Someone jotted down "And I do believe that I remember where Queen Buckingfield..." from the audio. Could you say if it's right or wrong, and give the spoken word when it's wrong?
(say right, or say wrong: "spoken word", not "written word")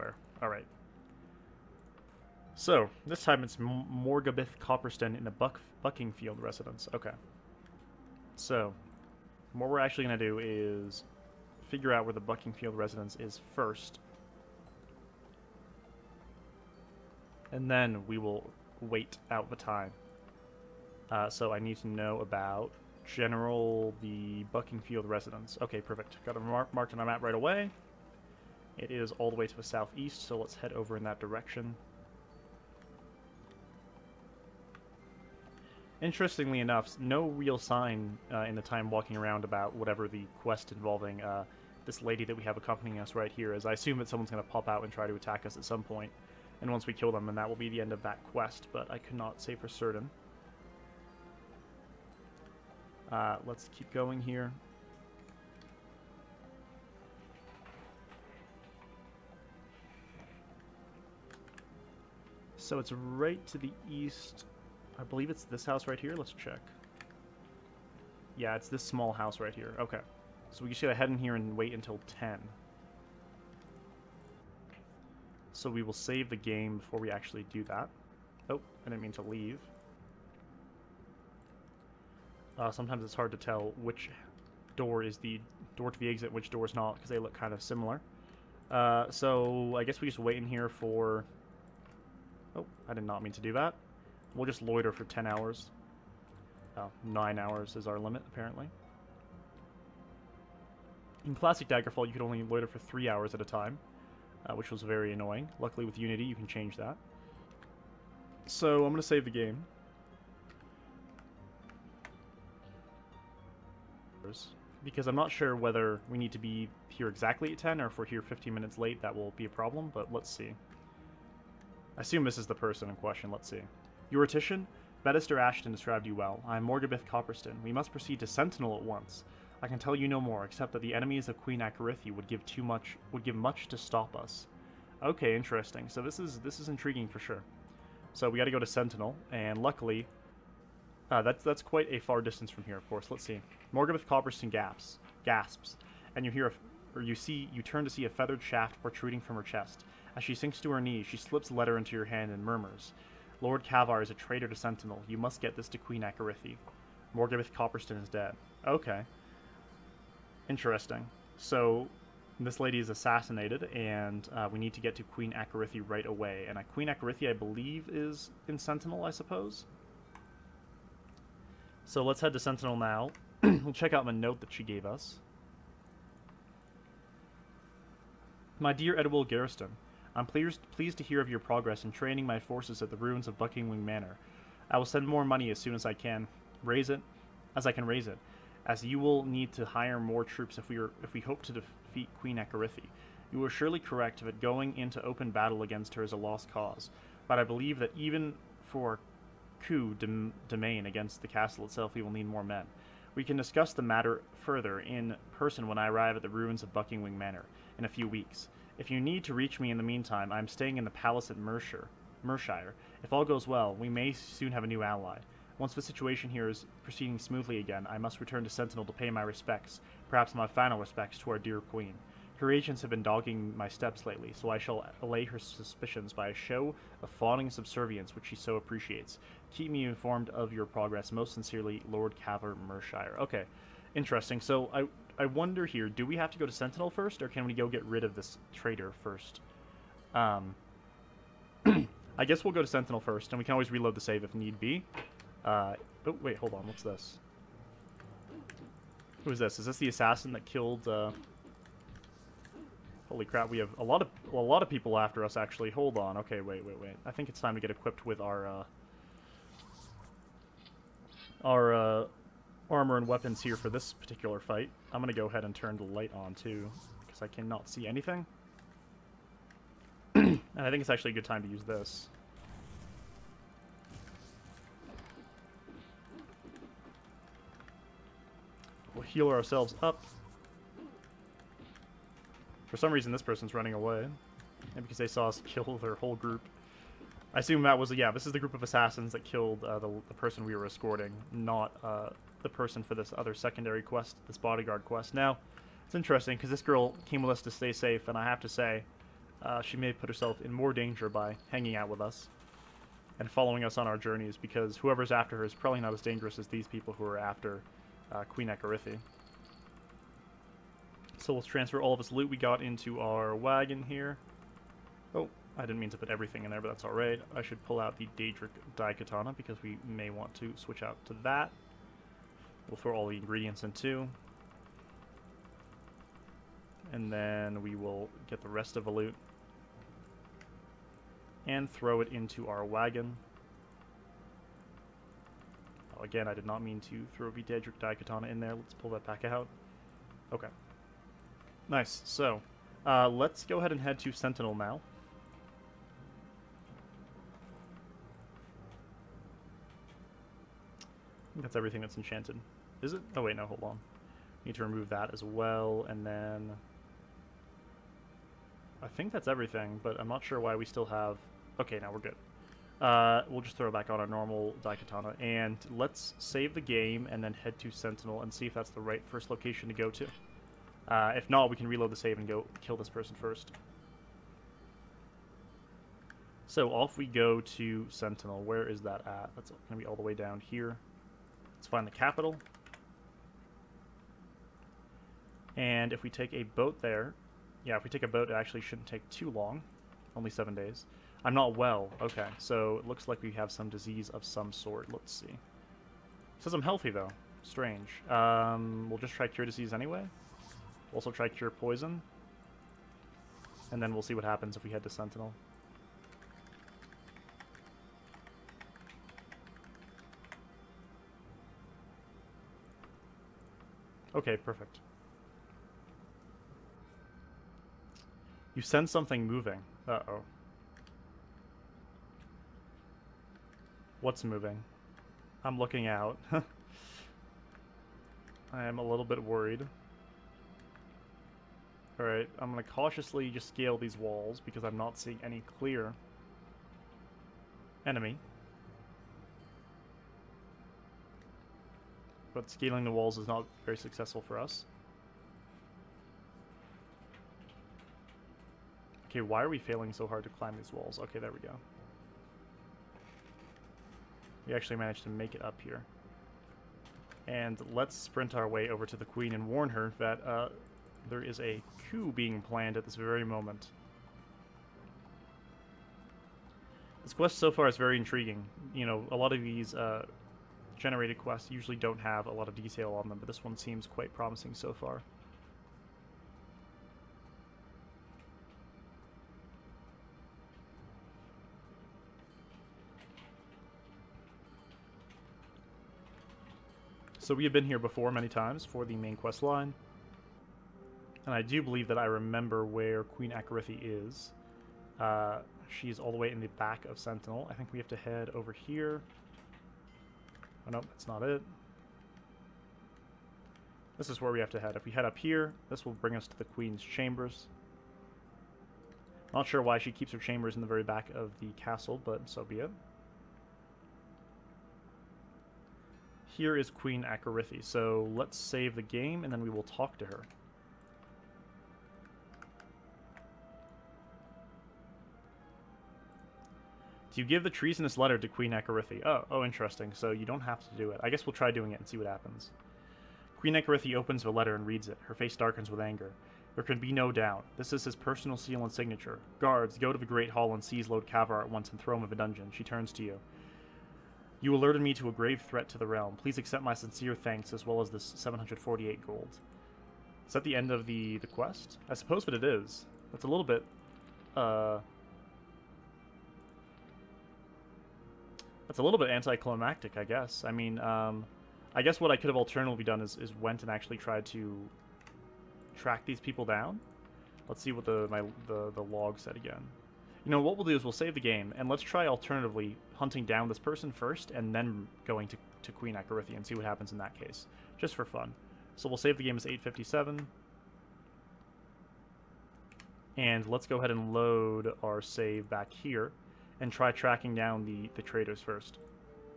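wrong: "Akorithi", not "Buckingfield".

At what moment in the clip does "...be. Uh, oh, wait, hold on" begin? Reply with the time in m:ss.
4:04.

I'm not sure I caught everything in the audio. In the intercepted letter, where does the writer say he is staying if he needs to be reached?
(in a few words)
the palace at Mershire.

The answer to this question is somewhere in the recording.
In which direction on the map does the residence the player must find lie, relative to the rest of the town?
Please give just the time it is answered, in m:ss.
0:29.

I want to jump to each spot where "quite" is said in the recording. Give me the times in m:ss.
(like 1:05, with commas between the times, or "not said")
2:21, 7:53.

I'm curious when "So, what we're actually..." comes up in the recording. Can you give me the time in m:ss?
0:08.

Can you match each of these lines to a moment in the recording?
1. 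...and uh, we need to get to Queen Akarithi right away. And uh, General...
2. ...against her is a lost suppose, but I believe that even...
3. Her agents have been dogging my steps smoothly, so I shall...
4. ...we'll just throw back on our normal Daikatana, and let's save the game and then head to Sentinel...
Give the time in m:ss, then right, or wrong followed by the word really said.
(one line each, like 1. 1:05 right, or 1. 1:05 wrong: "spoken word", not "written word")
1. 2:43 wrong: "Queen", not "General"
2. 3:15 wrong: "cause", not "suppose"
3. 3:42 wrong: "lately", not "smoothly"
4. 6:03 right.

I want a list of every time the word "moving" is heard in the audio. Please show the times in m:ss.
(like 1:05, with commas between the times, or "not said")
6:59, 7:04.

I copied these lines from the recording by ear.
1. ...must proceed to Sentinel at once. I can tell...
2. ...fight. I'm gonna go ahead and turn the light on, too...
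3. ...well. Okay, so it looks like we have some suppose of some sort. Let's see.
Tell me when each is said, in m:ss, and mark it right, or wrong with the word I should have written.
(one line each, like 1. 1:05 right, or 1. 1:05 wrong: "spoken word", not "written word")
1. 2:07 right
2. 4:24 right
3. 6:31 wrong: "disease", not "suppose".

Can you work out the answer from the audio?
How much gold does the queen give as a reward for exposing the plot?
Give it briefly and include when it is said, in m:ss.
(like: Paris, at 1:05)
748, at 9:08.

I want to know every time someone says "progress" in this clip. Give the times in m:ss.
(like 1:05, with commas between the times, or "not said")
3:01, 3:50.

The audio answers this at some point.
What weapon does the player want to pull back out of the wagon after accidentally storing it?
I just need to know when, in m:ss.
5:18.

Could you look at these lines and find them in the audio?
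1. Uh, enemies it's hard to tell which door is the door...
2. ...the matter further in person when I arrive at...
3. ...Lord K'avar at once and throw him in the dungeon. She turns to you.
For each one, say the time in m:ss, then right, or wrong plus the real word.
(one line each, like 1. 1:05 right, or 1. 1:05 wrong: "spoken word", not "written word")
1. 1:22 wrong: "sometimes", not "enemies"
2. 3:23 right
3. 9:00 right.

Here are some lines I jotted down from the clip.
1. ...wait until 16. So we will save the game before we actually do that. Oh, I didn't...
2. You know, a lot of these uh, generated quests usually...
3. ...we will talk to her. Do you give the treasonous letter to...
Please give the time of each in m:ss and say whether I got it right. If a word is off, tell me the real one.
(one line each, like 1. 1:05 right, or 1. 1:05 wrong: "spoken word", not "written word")
1. 1:11 wrong: "10", not "16"
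2. 7:48 right
3. 8:39 right.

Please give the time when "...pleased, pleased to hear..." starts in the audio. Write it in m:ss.
3:00.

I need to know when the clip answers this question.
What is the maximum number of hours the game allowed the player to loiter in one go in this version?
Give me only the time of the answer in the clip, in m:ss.
1:37.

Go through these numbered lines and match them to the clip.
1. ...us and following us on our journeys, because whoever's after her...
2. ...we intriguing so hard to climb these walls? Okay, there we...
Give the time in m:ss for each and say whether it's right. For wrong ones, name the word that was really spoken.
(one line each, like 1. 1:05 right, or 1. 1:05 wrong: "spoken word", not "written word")
1. 5:01 right
2. 7:29 wrong: "failing", not "intriguing".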